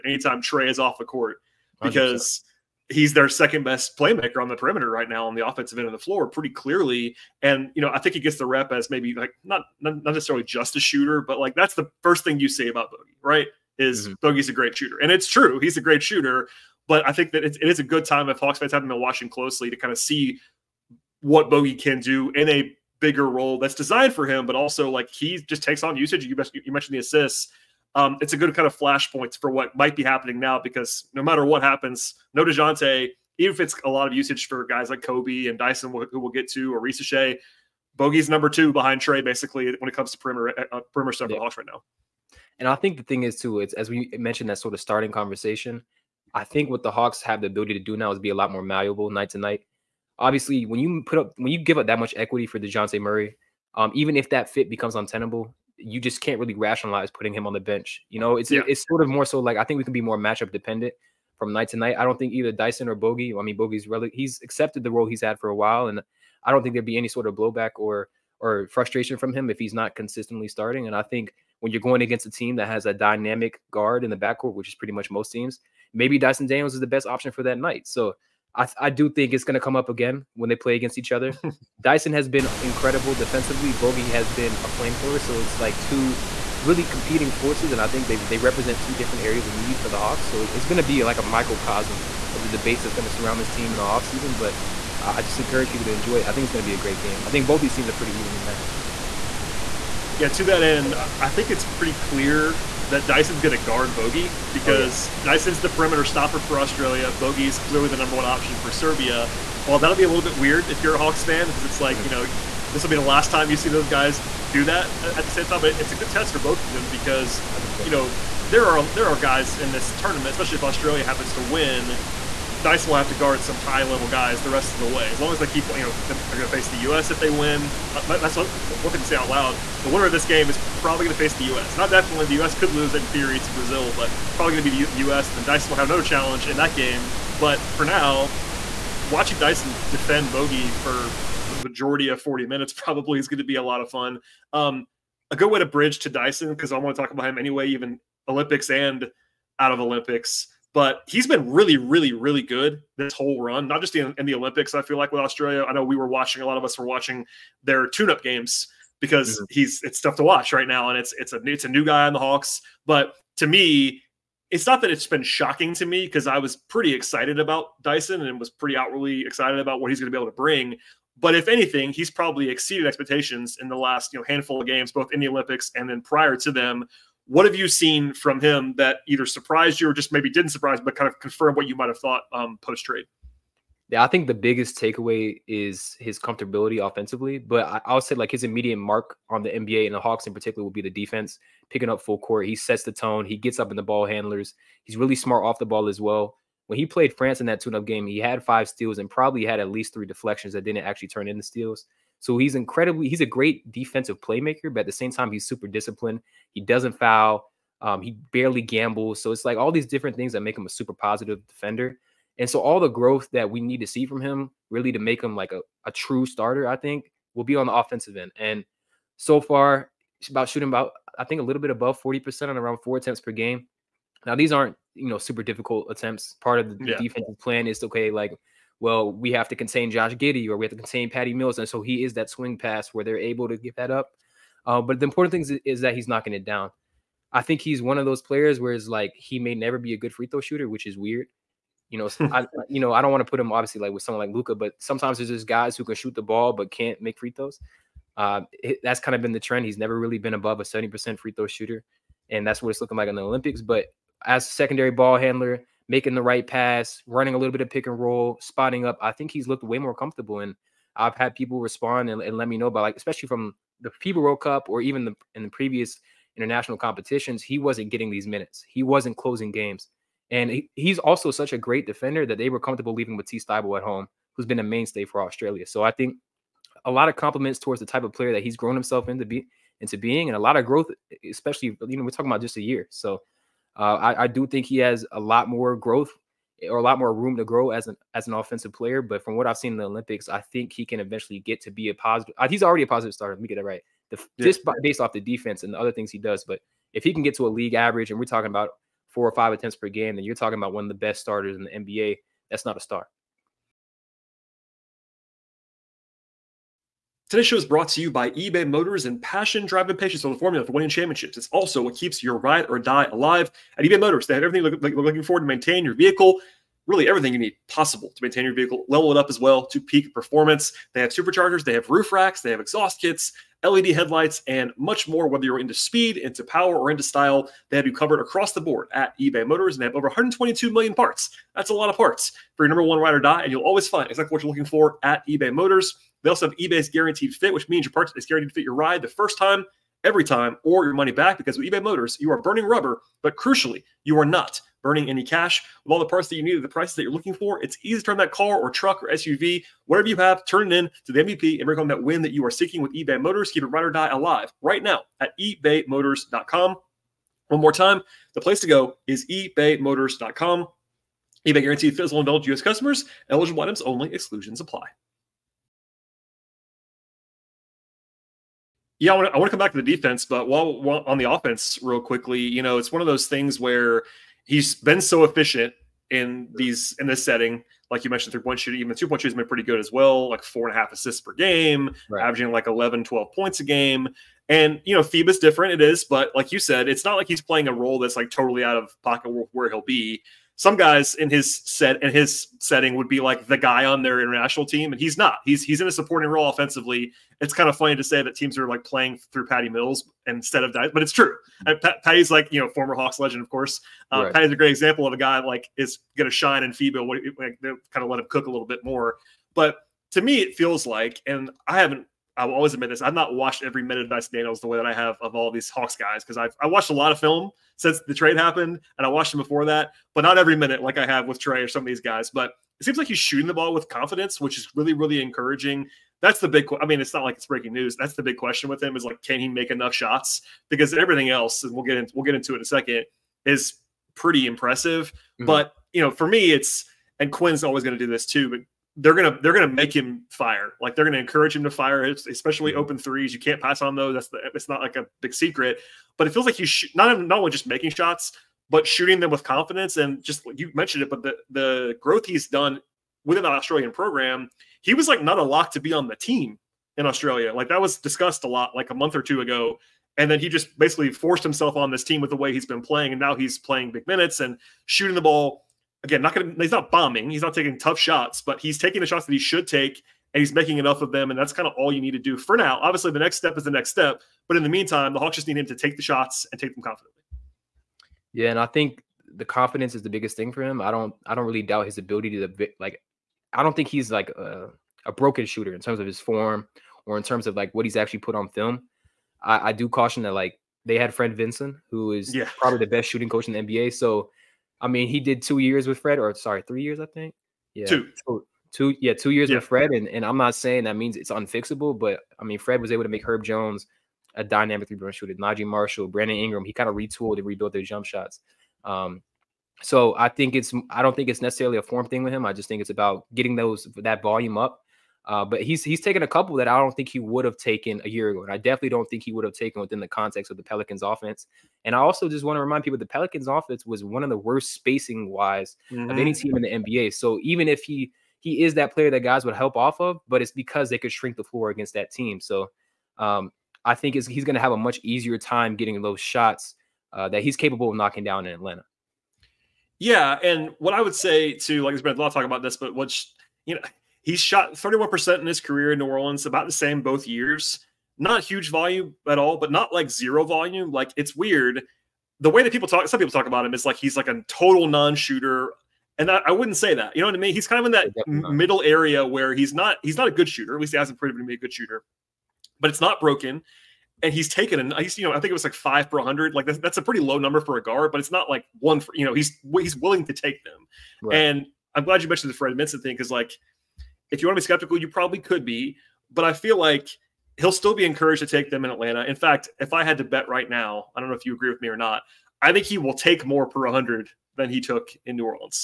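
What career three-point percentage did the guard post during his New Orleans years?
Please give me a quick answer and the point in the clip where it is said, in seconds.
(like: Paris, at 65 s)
31%, at 544 s.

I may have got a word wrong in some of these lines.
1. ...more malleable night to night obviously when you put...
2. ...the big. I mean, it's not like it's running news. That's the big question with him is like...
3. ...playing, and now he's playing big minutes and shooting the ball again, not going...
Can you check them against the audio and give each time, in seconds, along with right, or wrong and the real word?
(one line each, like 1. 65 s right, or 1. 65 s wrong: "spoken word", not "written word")
1. 48 s right
2. 426 s wrong: "breaking", not "running"
3. 462 s right.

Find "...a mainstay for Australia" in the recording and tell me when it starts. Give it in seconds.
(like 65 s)
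274 s.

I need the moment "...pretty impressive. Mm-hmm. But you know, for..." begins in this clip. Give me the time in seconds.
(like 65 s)
434 s.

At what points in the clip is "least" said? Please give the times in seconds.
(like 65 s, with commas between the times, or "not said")
199 s, 560 s.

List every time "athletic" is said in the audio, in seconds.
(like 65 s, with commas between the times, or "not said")
not said.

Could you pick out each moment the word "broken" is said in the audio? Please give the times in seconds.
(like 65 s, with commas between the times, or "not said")
485 s, 563 s.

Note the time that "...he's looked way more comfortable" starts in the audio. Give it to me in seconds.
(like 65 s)
259 s.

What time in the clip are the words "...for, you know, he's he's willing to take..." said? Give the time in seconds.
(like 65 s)
568 s.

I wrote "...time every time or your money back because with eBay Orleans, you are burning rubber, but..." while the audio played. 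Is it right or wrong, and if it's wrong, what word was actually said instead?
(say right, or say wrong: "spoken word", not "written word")
wrong: "Motors", not "Orleans".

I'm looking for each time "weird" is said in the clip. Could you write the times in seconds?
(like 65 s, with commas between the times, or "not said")
110 s, 240 s, 551 s.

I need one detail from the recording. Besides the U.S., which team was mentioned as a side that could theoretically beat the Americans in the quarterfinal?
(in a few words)
Brazil.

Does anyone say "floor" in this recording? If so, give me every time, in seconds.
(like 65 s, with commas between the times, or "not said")
5 s, 531 s.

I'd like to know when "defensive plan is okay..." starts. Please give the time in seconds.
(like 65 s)
226 s.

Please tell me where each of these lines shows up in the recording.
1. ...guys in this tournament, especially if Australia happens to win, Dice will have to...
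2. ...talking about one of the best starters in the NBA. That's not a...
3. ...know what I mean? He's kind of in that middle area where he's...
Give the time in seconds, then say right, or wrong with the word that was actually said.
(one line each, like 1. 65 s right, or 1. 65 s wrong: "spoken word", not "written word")
1. 119 s right
2. 300 s right
3. 557 s right.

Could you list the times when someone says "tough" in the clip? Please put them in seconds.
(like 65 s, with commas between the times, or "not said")
159 s, 467 s.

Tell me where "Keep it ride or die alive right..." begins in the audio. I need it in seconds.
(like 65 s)
353 s.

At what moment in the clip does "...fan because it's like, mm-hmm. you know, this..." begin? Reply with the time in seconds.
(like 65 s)
111 s.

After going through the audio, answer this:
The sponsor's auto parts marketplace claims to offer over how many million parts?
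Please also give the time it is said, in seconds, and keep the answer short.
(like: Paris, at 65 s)
122 million, at 330 s.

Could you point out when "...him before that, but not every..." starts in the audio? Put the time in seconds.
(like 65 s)
419 s.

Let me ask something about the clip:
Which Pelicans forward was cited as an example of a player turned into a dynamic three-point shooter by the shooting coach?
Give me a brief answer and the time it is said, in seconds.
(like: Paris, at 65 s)
Herb Jones, at 503 s.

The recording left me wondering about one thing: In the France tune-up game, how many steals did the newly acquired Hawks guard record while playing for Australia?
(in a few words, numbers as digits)
5.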